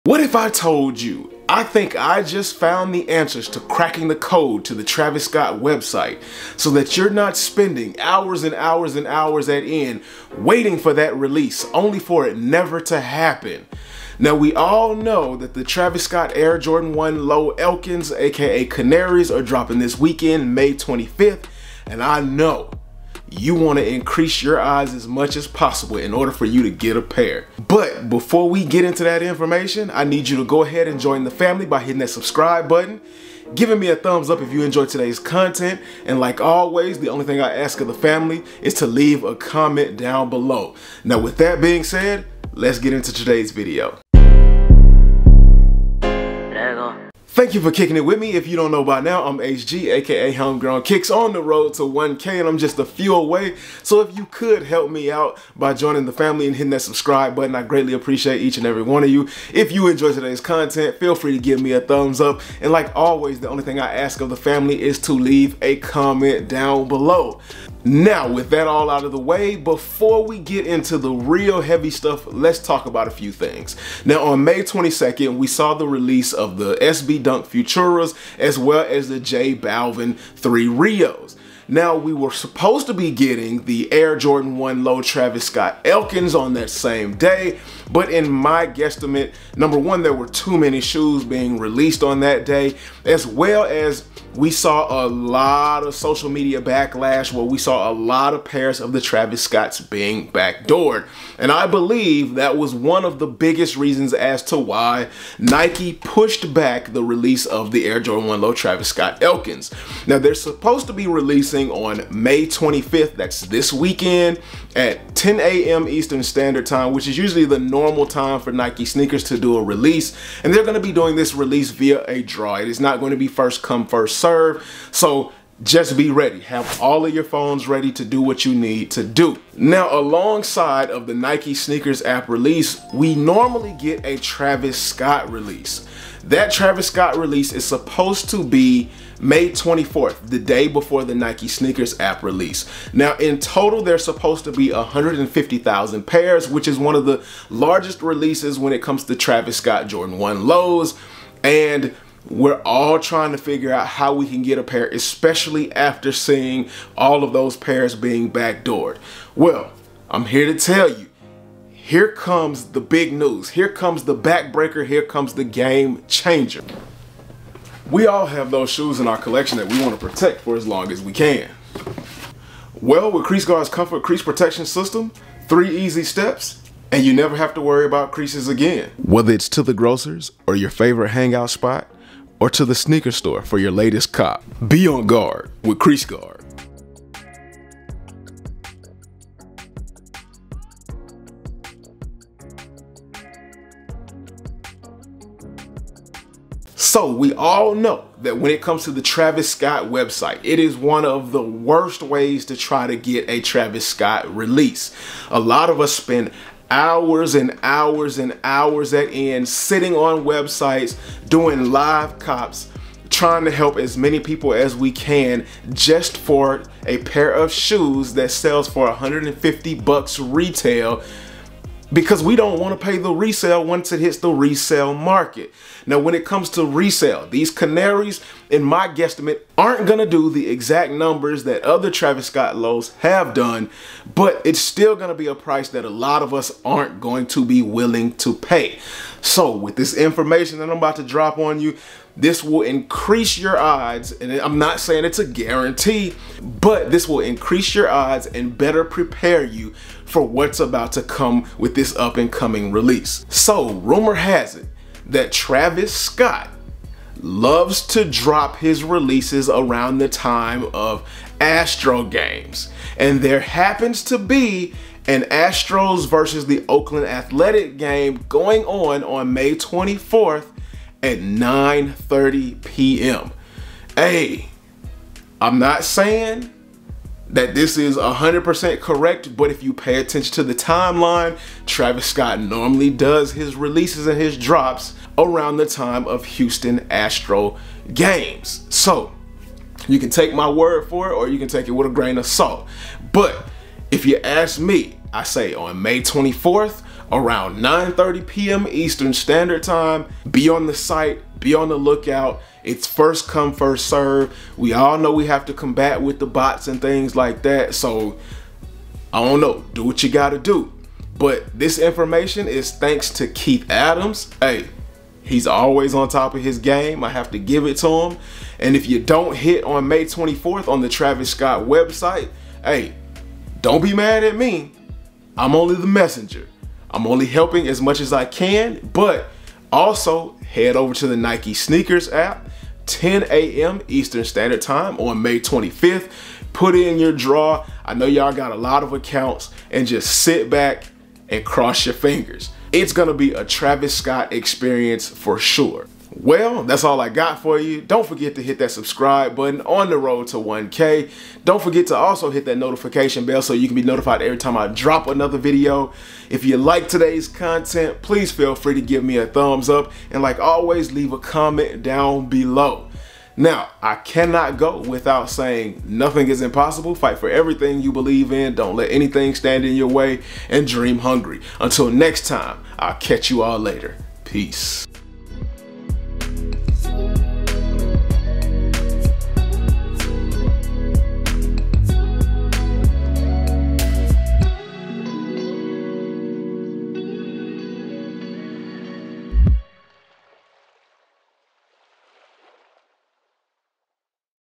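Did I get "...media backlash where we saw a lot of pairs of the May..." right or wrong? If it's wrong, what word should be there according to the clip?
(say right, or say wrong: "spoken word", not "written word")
wrong: "Travis", not "May".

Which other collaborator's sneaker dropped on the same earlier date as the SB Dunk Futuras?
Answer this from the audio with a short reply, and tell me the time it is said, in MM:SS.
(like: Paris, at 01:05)
J Balvin 3 Rios, at 01:19.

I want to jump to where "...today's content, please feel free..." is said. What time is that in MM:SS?
05:56.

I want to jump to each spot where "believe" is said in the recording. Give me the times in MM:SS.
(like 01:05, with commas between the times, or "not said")
01:41, 06:07.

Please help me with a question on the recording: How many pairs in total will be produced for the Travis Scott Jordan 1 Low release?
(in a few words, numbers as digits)
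150,000.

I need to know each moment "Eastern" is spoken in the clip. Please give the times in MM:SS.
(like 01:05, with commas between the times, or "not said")
01:55, 04:58, 05:33.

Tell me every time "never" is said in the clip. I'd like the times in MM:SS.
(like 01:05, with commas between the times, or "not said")
00:12, 02:57.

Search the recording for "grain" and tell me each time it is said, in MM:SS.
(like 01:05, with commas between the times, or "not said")
04:51.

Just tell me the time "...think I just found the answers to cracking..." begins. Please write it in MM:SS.
00:01.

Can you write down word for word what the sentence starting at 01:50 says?
Now, they're supposed to be releasing on May 25th.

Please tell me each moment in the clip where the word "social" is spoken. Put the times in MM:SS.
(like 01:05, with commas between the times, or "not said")
01:35.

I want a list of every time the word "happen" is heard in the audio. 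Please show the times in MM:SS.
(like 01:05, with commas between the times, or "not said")
00:12, 04:23.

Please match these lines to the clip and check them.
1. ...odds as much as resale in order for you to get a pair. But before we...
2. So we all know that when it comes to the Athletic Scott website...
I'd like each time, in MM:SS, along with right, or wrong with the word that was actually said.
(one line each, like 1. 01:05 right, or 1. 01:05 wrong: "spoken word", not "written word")
1. 00:24 wrong: "possible", not "resale"
2. 03:16 wrong: "Travis", not "Athletic".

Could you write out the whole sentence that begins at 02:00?
And they're going to be doing this release via a draw.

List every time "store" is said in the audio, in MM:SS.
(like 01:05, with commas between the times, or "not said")
03:03.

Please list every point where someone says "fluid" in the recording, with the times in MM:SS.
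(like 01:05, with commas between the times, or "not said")
not said.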